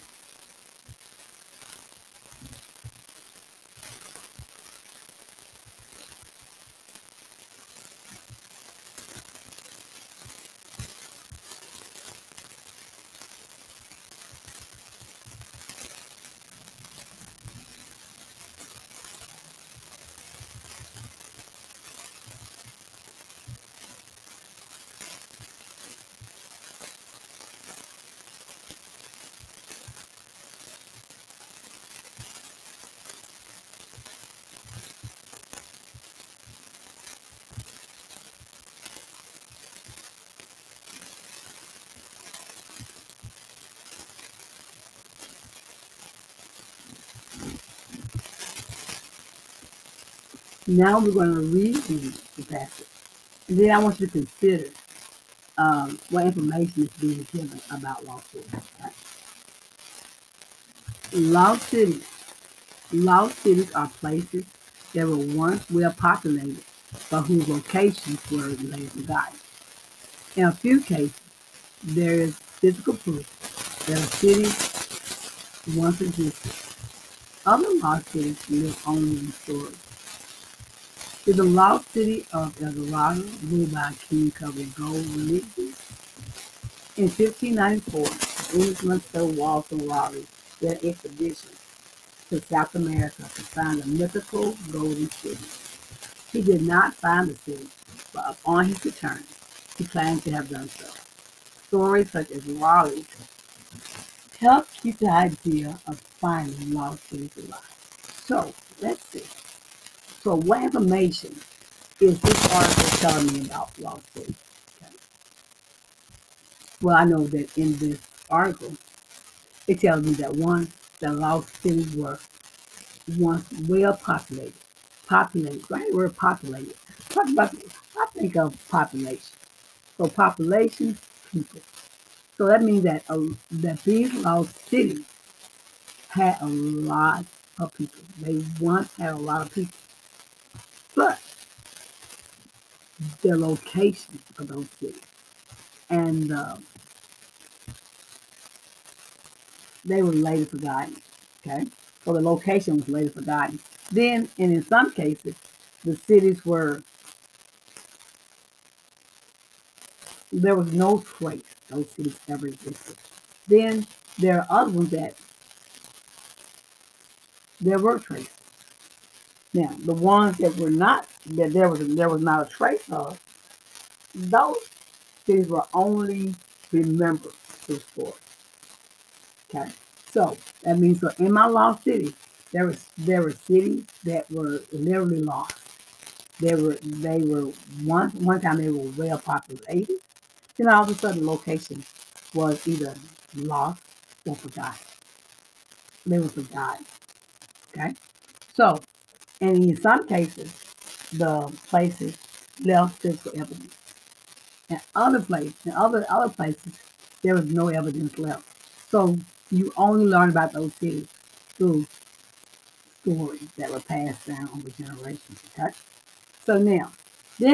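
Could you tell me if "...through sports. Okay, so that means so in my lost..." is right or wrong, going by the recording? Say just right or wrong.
right.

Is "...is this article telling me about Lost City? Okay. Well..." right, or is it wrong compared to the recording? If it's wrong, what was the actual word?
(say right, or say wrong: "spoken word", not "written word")
right.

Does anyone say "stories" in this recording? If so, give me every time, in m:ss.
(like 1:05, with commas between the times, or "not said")
1:19, 1:41, 3:33.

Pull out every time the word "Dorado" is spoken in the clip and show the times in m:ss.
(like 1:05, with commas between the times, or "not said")
1:22.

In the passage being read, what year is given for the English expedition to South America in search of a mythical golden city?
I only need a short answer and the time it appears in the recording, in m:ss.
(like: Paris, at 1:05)
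1594, at 1:27.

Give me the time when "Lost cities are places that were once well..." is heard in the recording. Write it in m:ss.
1:02.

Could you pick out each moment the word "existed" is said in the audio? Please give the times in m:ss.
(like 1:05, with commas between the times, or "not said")
1:16, 2:42.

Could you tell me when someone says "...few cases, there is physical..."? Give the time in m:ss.
1:10.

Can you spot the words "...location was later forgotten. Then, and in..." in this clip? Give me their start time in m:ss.
2:32.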